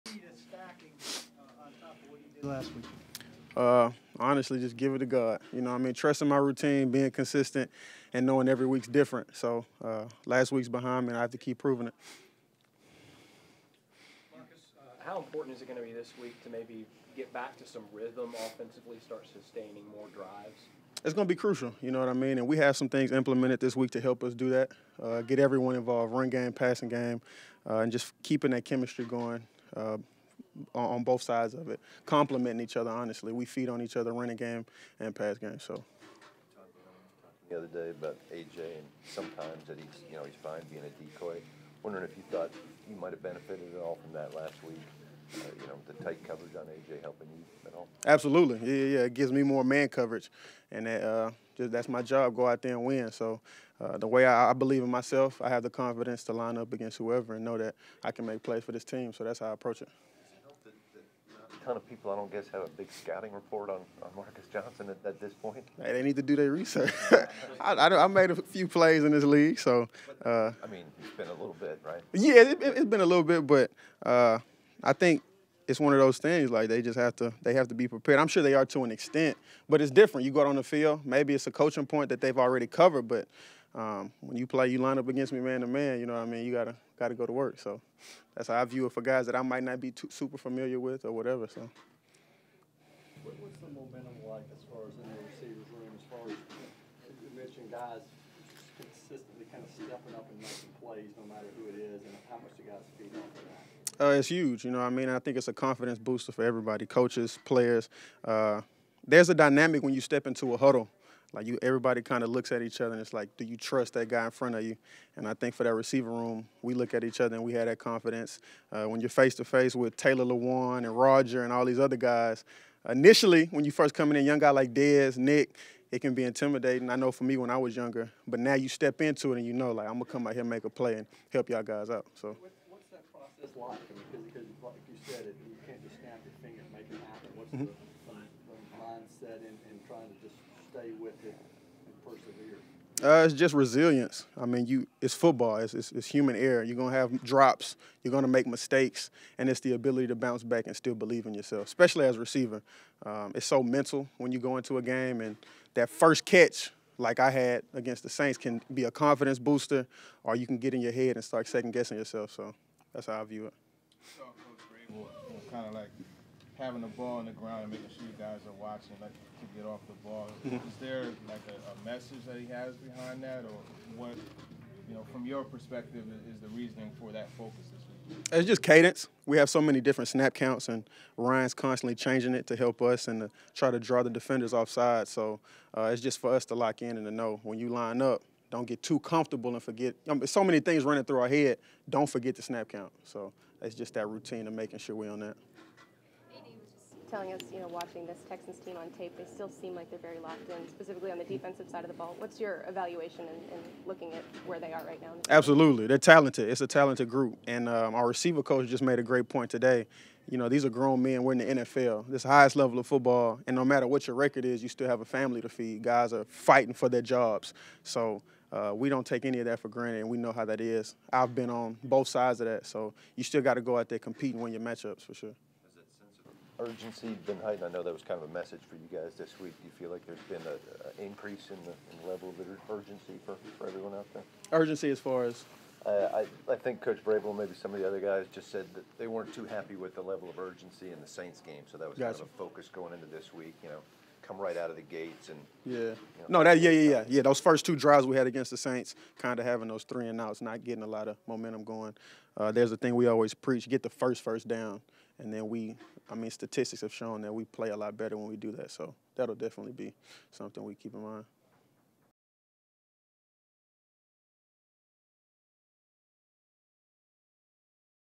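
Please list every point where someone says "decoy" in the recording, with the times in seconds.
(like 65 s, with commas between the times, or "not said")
41 s.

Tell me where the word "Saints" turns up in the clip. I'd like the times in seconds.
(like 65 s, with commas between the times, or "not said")
158 s, 241 s, 248 s.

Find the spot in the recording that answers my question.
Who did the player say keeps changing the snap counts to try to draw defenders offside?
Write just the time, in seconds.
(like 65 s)
181 s.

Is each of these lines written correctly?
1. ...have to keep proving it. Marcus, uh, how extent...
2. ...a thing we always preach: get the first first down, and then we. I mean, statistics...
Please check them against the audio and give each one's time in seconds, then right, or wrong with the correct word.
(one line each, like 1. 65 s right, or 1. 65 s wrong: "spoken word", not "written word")
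1. 11 s wrong: "important", not "extent"
2. 252 s right.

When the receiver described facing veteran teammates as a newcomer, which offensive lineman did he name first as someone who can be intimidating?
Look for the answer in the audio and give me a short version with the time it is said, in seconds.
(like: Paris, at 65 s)
Taylor Lewan, at 119 s.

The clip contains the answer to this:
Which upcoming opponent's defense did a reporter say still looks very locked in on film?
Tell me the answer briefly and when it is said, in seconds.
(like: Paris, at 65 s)
Texans, at 198 s.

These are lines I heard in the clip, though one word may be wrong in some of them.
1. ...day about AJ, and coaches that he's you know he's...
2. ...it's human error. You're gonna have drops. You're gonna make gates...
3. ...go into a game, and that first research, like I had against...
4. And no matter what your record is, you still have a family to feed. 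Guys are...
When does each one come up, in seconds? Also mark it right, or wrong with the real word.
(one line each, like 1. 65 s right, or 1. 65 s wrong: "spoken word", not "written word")
1. 37 s wrong: "sometimes", not "coaches"
2. 145 s wrong: "mistakes", not "gates"
3. 154 s wrong: "catch", not "research"
4. 213 s right.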